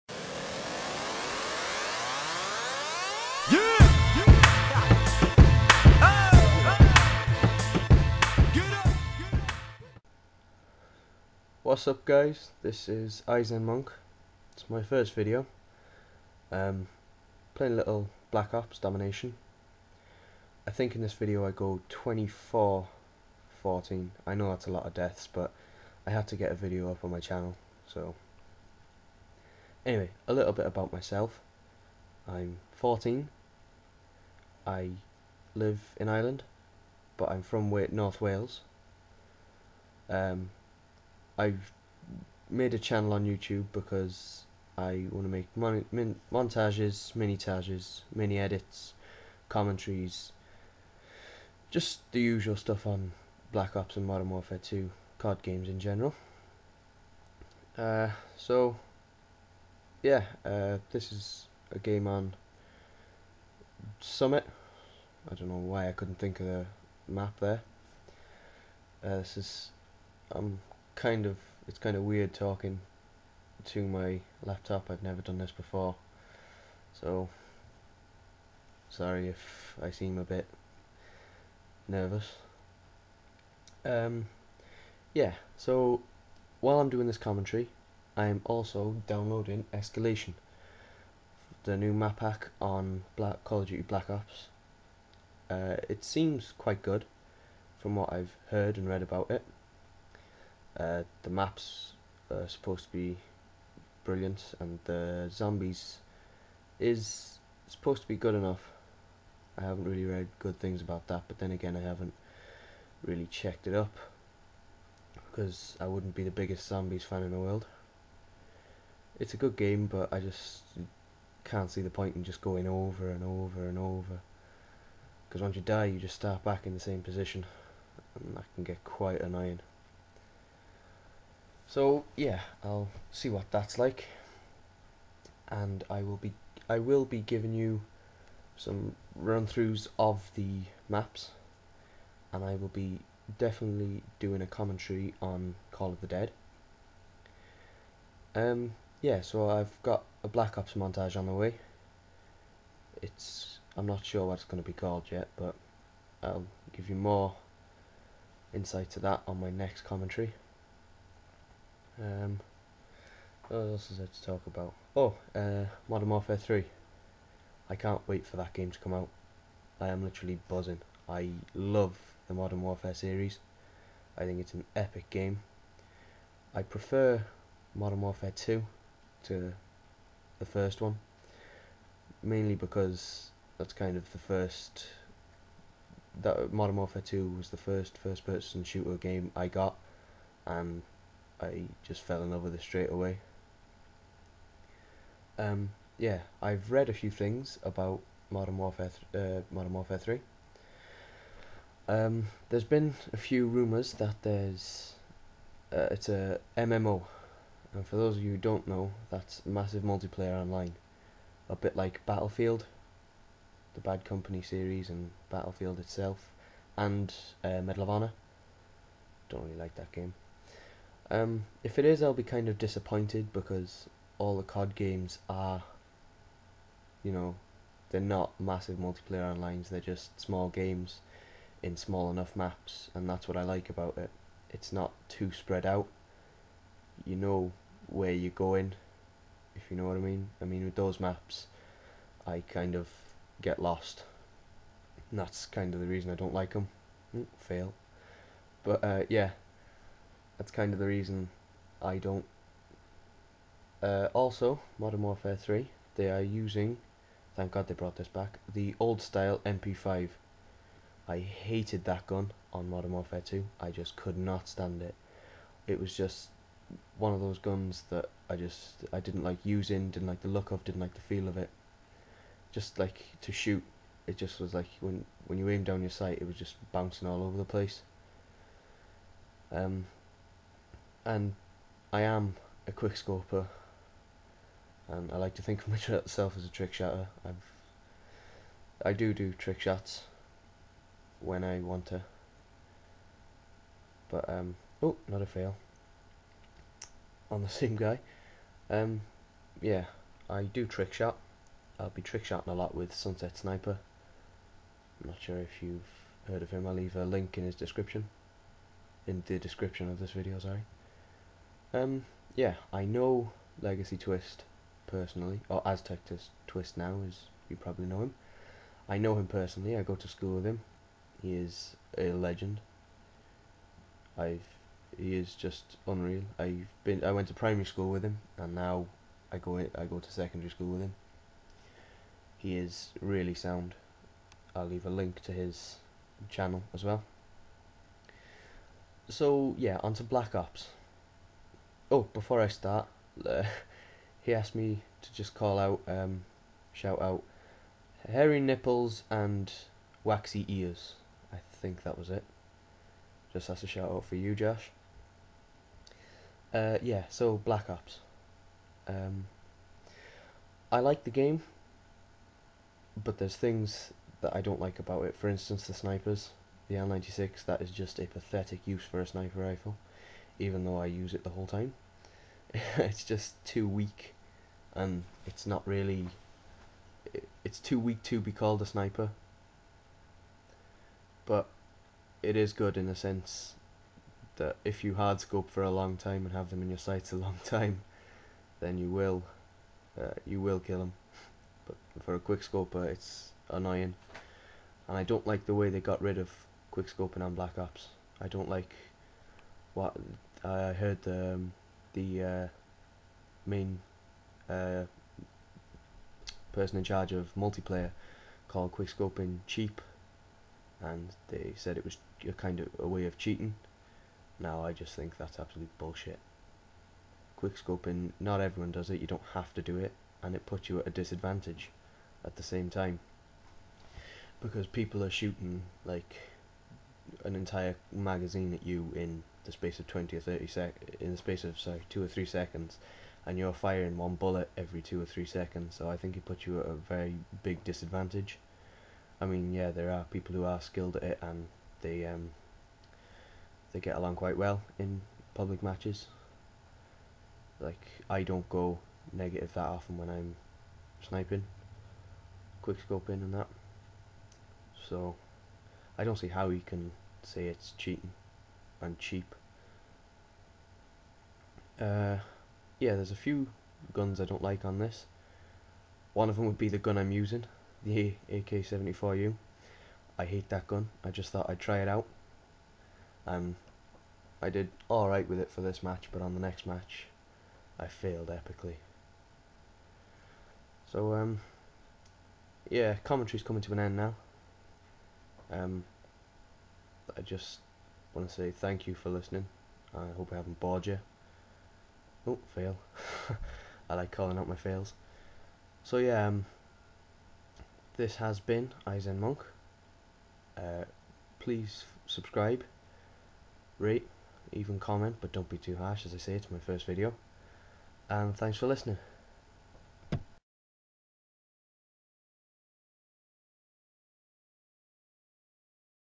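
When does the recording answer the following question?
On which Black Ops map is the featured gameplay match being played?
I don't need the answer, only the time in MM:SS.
01:04.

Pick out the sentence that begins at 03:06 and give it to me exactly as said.
That Modern Warfare 2 was the first first-person shooter game I got, and I just fell in love with it straight away.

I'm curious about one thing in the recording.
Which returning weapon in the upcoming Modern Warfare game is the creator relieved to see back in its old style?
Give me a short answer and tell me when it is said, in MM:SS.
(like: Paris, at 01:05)
MP5, at 04:19.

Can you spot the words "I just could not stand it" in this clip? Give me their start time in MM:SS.
04:23.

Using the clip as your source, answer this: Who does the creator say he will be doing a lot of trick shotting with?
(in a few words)
Sunset Sniper.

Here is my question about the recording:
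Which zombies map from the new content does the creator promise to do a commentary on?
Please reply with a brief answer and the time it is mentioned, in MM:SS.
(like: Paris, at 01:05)
Call of the Dead, at 02:25.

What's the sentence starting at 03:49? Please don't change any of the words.
they're just small games in small enough maps, and that's what I like about it.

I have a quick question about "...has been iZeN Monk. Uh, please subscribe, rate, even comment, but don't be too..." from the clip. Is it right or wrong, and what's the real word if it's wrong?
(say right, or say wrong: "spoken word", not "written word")
right.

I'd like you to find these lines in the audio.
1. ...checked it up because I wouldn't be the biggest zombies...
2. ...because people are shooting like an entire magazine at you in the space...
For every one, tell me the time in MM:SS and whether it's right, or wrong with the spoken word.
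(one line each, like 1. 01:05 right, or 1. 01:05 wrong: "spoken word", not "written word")
1. 01:53 right
2. 07:04 right.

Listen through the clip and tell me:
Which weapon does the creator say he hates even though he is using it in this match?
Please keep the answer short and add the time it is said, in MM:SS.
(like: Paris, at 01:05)
AK-74U, at 07:48.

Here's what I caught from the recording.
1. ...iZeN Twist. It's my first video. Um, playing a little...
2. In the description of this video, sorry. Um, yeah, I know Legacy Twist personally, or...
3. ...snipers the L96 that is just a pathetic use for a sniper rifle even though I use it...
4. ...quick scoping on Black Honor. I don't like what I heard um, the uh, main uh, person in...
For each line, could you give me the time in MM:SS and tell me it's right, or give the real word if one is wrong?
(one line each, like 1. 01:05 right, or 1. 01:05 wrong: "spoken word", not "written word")
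1. 00:13 wrong: "Monk", not "Twist"
2. 05:09 right
3. 06:05 right
4. 06:36 wrong: "Ops", not "Honor".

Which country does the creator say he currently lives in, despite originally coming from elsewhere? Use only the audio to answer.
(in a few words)
Ireland.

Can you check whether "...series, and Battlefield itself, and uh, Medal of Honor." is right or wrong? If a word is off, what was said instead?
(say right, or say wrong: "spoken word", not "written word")
right.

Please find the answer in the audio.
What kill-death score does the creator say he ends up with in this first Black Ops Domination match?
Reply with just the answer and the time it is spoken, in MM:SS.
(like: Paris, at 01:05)
24-14, at 00:21.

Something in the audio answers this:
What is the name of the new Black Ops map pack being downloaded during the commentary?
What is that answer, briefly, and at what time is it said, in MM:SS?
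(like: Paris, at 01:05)
Escalation, at 01:29.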